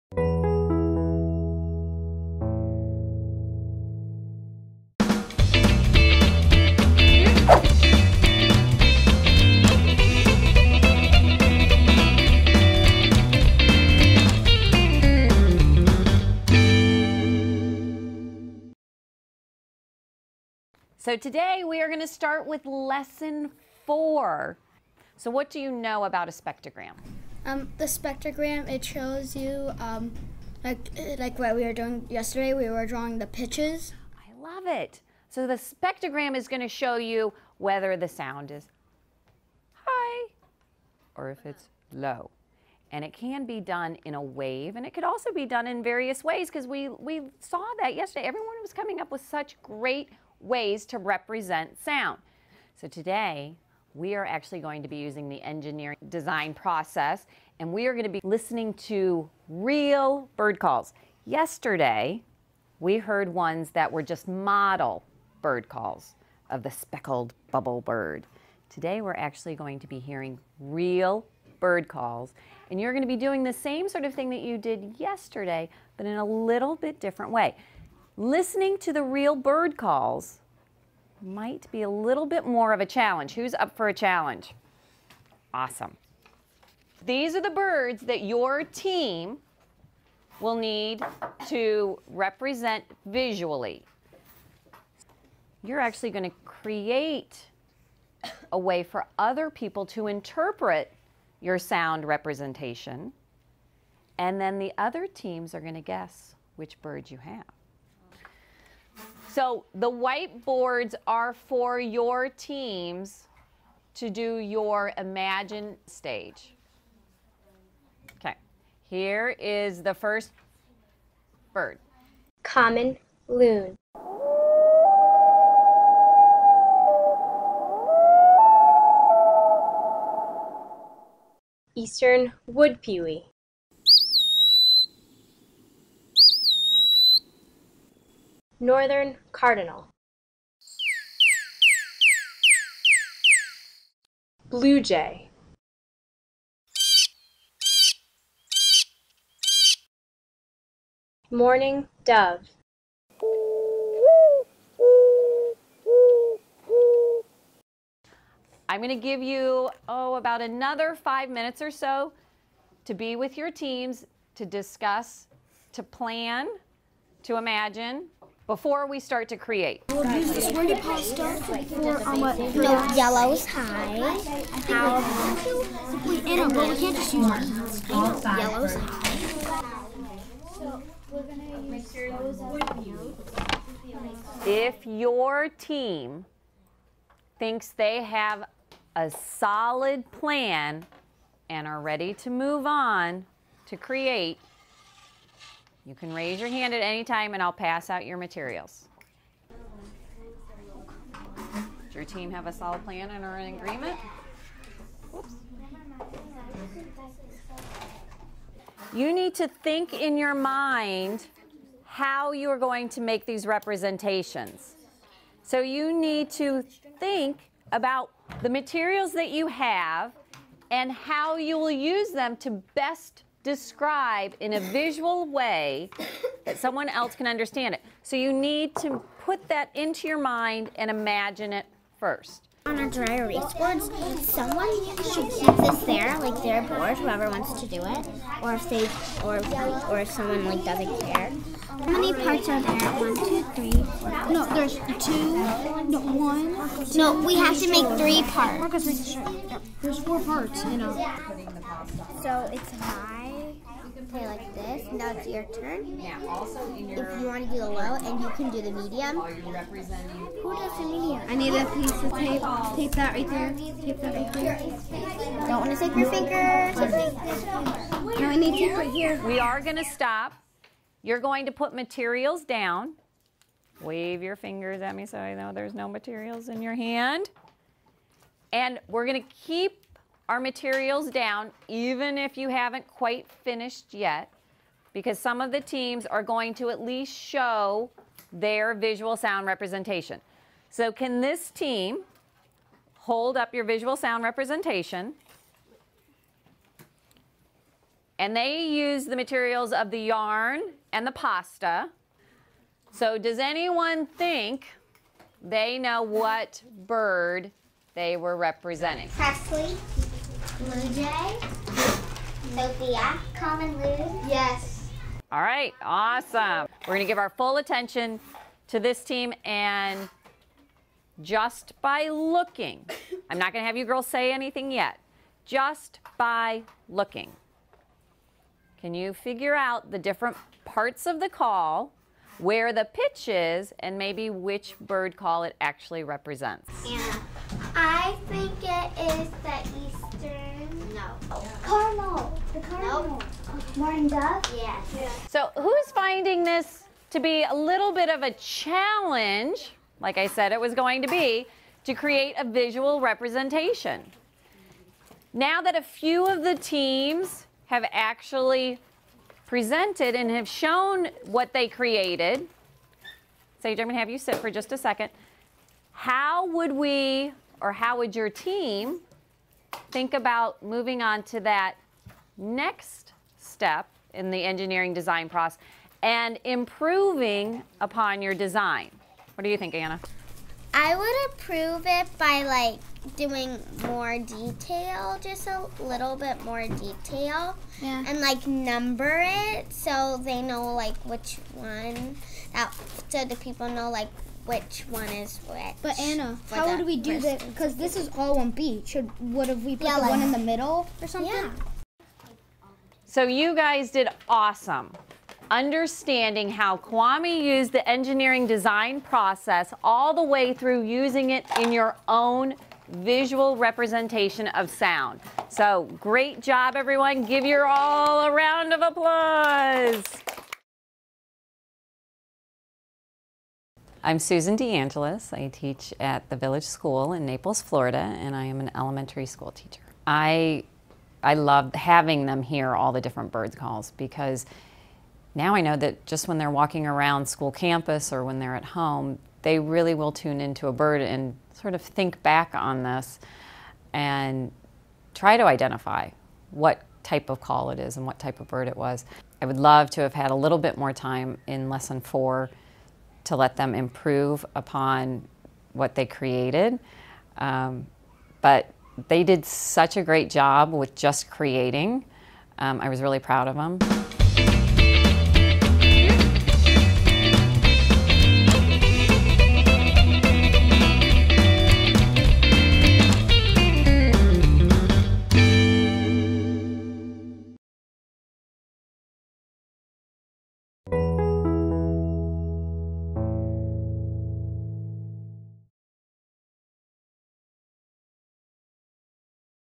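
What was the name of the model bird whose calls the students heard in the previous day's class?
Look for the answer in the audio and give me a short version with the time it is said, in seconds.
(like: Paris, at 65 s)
Speckled bubble bird, at 66 s.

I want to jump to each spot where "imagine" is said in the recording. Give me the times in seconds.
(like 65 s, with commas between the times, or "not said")
114 s, 167 s, 230 s.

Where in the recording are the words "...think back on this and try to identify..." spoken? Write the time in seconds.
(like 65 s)
441 s.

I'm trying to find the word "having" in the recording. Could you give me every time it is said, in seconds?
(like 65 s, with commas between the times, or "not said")
431 s.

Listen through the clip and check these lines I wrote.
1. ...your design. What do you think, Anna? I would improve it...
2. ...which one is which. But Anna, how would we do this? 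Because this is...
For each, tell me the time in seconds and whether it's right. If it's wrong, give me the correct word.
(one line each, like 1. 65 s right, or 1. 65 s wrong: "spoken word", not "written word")
1. 378 s right
2. 394 s right.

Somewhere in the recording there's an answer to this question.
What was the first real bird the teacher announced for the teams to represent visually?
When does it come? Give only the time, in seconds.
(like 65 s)
122 s.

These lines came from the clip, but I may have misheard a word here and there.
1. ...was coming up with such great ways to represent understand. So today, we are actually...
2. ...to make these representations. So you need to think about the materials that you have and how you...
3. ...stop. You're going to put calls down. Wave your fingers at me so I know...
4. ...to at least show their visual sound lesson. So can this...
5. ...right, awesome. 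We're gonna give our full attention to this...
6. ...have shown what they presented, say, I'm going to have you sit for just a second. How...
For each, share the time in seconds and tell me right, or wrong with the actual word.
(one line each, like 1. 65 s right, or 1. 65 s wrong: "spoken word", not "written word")
1. 48 s wrong: "sound", not "understand"
2. 212 s right
3. 269 s wrong: "materials", not "calls"
4. 286 s wrong: "representation", not "lesson"
5. 315 s right
6. 360 s wrong: "created", not "presented".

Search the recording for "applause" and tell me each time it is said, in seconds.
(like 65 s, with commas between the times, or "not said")
418 s.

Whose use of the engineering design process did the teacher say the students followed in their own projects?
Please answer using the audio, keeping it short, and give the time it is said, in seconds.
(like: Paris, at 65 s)
Kwame, at 406 s.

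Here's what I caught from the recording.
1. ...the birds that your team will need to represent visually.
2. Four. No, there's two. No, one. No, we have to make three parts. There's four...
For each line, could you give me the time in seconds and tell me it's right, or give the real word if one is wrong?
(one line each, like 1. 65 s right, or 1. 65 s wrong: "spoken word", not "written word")
1. 87 s right
2. 243 s right.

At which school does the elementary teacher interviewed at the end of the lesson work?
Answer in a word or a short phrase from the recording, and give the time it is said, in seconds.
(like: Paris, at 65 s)
Village School, at 426 s.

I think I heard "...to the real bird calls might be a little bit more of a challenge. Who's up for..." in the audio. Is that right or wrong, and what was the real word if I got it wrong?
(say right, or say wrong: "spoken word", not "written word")
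right.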